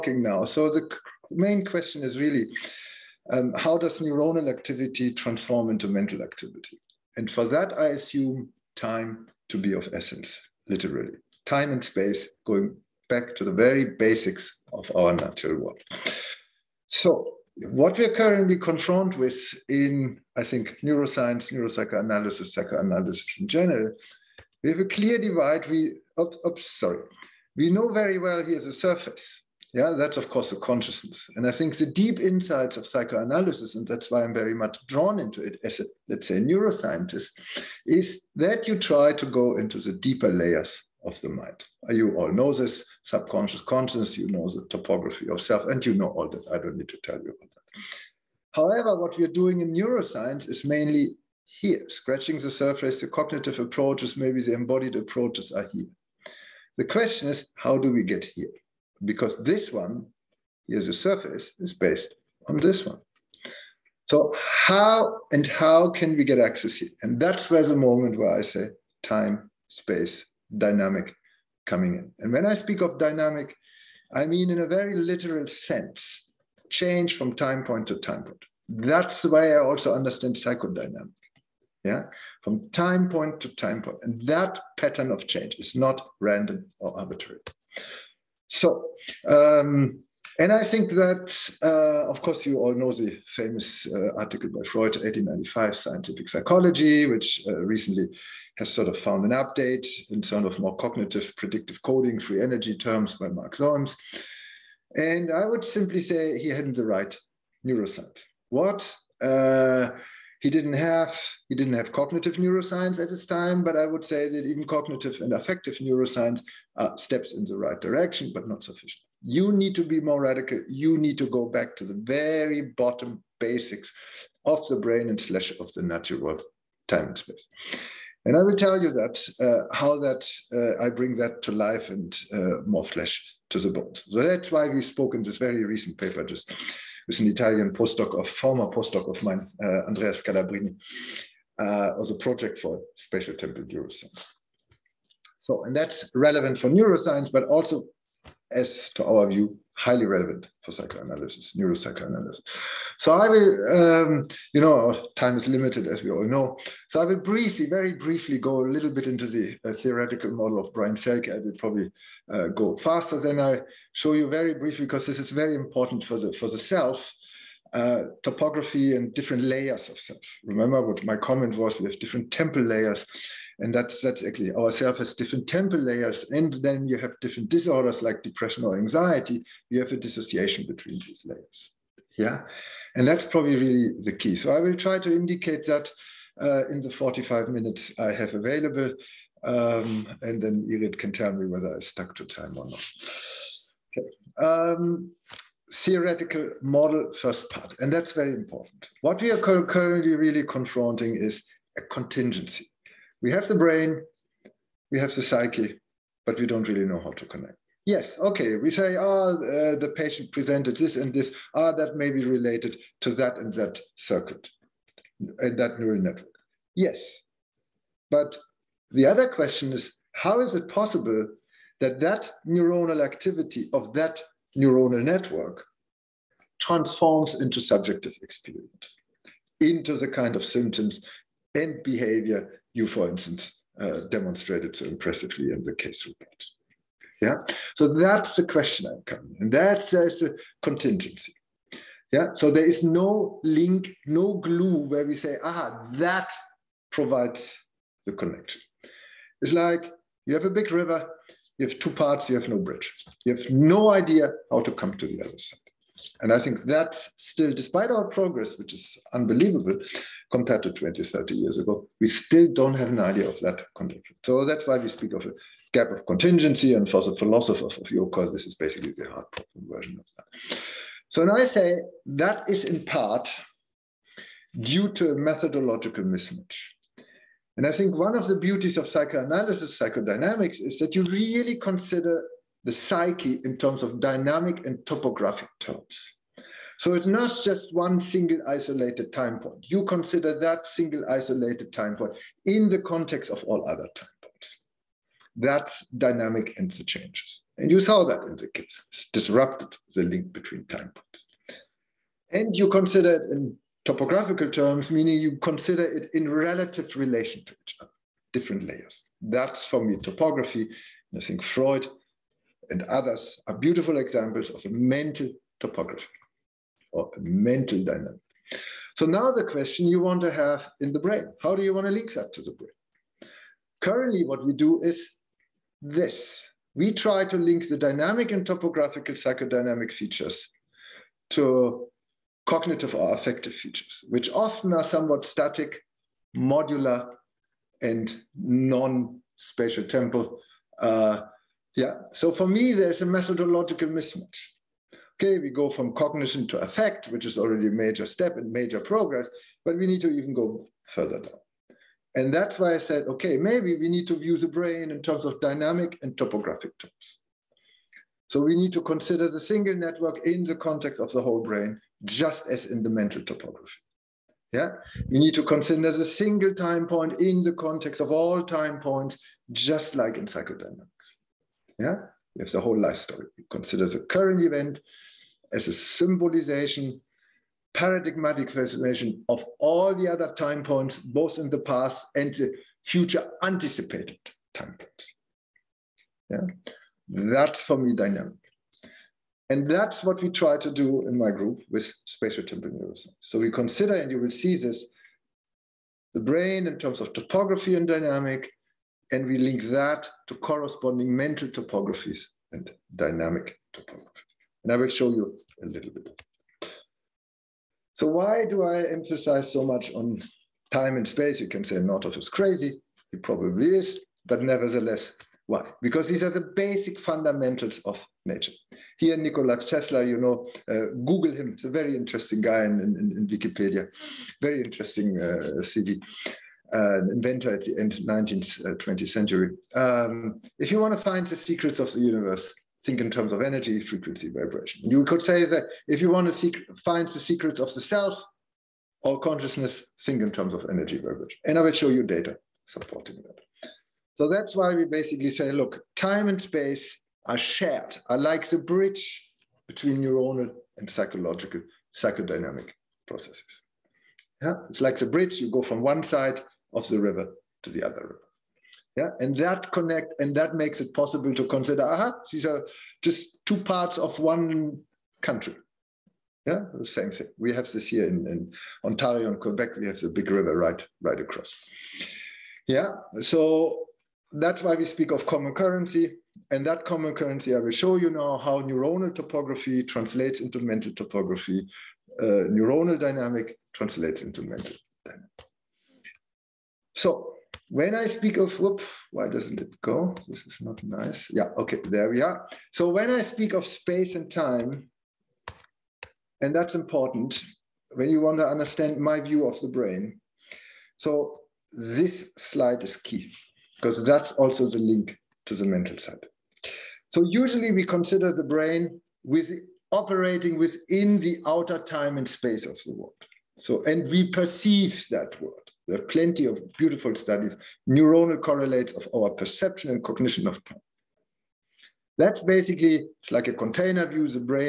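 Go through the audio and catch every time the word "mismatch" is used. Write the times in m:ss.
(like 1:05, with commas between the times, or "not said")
4:36, 5:43.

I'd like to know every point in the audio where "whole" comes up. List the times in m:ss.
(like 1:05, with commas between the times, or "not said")
6:01, 6:12.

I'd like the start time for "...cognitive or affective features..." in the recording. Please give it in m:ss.
5:32.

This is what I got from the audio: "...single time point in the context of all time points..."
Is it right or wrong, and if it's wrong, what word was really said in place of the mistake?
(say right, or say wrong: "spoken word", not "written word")
right.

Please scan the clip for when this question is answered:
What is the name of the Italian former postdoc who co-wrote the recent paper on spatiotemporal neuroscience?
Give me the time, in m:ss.
2:19.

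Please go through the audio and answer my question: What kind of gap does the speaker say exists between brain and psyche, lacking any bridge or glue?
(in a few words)
gap of contingency.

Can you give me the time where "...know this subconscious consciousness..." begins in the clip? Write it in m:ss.
0:42.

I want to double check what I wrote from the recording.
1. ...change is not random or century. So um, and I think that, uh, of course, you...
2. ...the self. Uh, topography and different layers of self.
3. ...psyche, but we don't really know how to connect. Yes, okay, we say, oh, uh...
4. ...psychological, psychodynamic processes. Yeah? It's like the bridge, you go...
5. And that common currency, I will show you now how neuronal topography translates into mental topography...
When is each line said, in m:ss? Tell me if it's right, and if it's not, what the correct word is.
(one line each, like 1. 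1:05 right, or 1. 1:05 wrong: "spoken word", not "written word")
1. 1:25 wrong: "arbitrary", not "century"
2. 2:46 right
3. 3:25 right
4. 7:30 right
5. 7:56 right.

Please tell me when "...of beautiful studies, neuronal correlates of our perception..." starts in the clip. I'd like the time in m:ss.
8:36.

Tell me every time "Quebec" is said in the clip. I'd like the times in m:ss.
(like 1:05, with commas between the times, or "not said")
7:49.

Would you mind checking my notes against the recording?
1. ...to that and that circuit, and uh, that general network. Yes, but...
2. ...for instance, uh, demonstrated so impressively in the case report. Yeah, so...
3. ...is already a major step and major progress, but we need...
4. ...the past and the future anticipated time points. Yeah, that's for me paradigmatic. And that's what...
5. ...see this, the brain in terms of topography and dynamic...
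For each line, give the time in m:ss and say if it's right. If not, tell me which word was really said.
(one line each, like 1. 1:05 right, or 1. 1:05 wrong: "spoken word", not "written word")
1. 3:33 wrong: "neural", not "general"
2. 3:52 right
3. 5:47 right
4. 6:21 wrong: "dynamic", not "paradigmatic"
5. 6:34 right.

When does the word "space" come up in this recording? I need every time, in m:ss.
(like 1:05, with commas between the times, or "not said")
0:11, 1:09, 2:07, 6:51, 7:26, 8:13, 8:32.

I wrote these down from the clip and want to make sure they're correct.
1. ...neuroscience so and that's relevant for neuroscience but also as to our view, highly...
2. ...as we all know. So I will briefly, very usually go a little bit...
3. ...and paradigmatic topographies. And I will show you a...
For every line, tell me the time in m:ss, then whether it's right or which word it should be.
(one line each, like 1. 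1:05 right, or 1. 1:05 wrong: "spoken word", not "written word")
1. 2:23 right
2. 2:35 wrong: "briefly", not "usually"
3. 6:42 wrong: "dynamic", not "paradigmatic".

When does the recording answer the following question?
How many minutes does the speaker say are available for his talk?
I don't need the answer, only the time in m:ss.
3:06.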